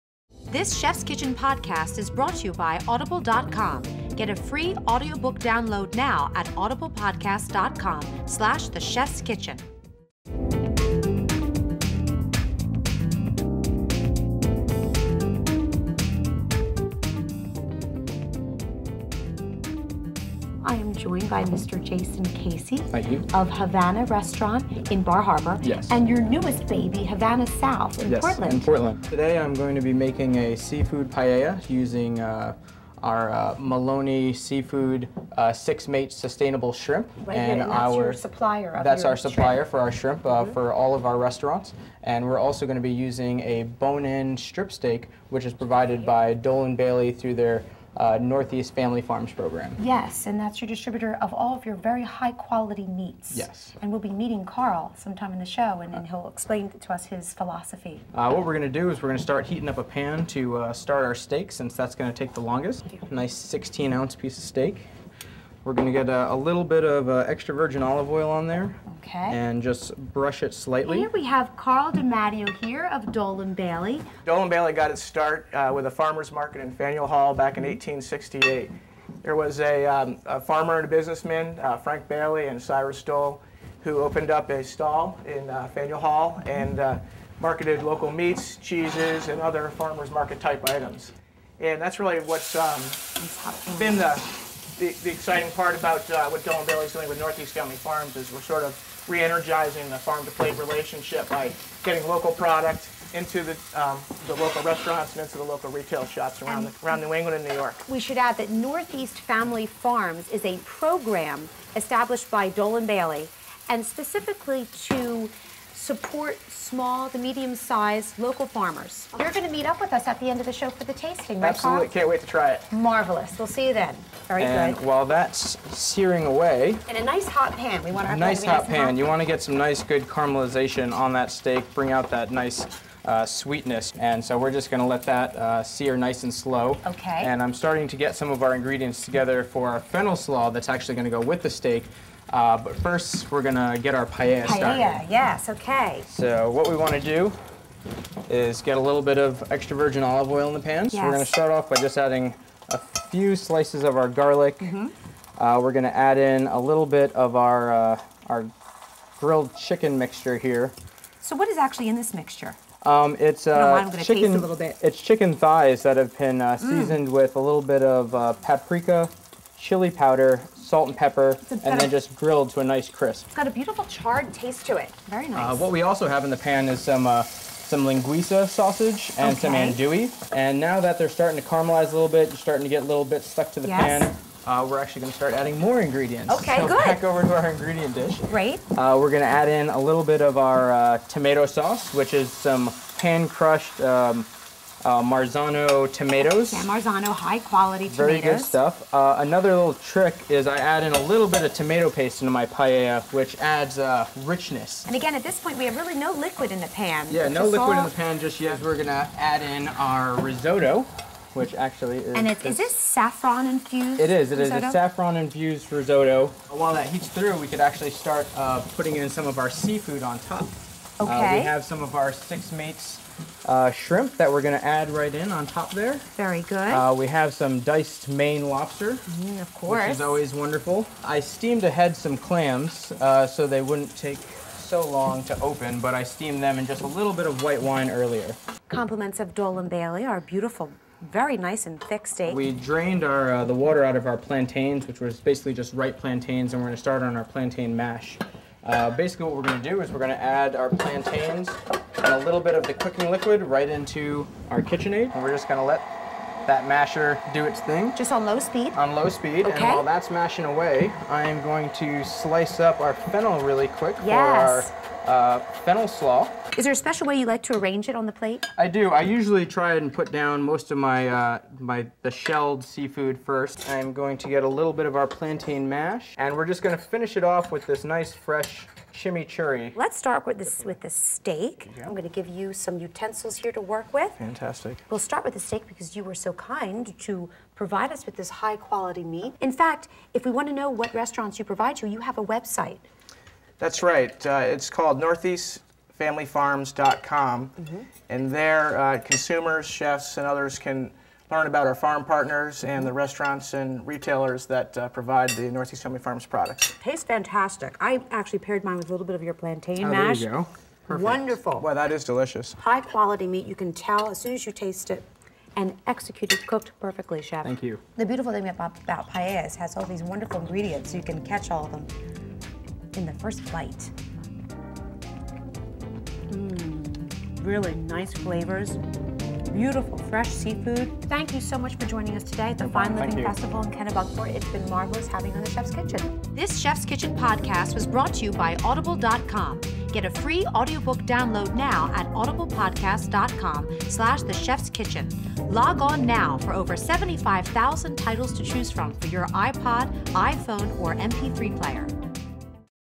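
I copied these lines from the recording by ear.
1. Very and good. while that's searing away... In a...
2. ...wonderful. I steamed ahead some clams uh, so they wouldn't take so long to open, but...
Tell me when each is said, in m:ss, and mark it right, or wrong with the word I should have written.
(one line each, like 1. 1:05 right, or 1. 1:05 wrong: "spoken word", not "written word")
1. 2:04 right
2. 3:50 right.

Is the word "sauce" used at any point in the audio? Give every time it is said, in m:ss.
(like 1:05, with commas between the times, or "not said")
3:11.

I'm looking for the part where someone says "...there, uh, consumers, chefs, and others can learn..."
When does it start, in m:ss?
4:58.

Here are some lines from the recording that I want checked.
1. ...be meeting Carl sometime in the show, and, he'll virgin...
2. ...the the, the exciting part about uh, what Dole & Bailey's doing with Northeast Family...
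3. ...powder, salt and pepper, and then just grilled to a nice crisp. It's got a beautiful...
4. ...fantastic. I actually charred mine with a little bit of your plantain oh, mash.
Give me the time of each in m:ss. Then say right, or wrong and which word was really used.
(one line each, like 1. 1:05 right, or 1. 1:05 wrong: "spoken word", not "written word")
1. 0:53 wrong: "explain", not "virgin"
2. 1:33 right
3. 2:49 right
4. 5:07 wrong: "paired", not "charred".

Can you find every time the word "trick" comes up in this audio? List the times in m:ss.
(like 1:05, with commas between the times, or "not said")
3:19.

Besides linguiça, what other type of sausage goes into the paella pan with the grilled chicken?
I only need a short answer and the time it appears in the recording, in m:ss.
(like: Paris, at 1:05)
andouille, at 2:59.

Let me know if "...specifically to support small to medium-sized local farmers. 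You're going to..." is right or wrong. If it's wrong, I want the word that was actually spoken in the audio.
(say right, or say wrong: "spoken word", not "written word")
right.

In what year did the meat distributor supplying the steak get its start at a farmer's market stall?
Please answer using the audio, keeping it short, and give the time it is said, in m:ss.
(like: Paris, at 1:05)
1868, at 1:17.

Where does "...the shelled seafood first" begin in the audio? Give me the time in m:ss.
4:32.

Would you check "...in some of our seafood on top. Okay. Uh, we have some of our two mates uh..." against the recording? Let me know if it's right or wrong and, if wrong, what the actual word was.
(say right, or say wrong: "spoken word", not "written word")
wrong: "six", not "two".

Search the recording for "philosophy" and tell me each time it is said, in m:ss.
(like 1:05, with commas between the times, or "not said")
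0:57.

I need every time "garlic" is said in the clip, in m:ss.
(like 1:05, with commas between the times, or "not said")
2:34.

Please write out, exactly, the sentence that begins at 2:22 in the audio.
Uh, but first, we're gonna get our paella, paella started.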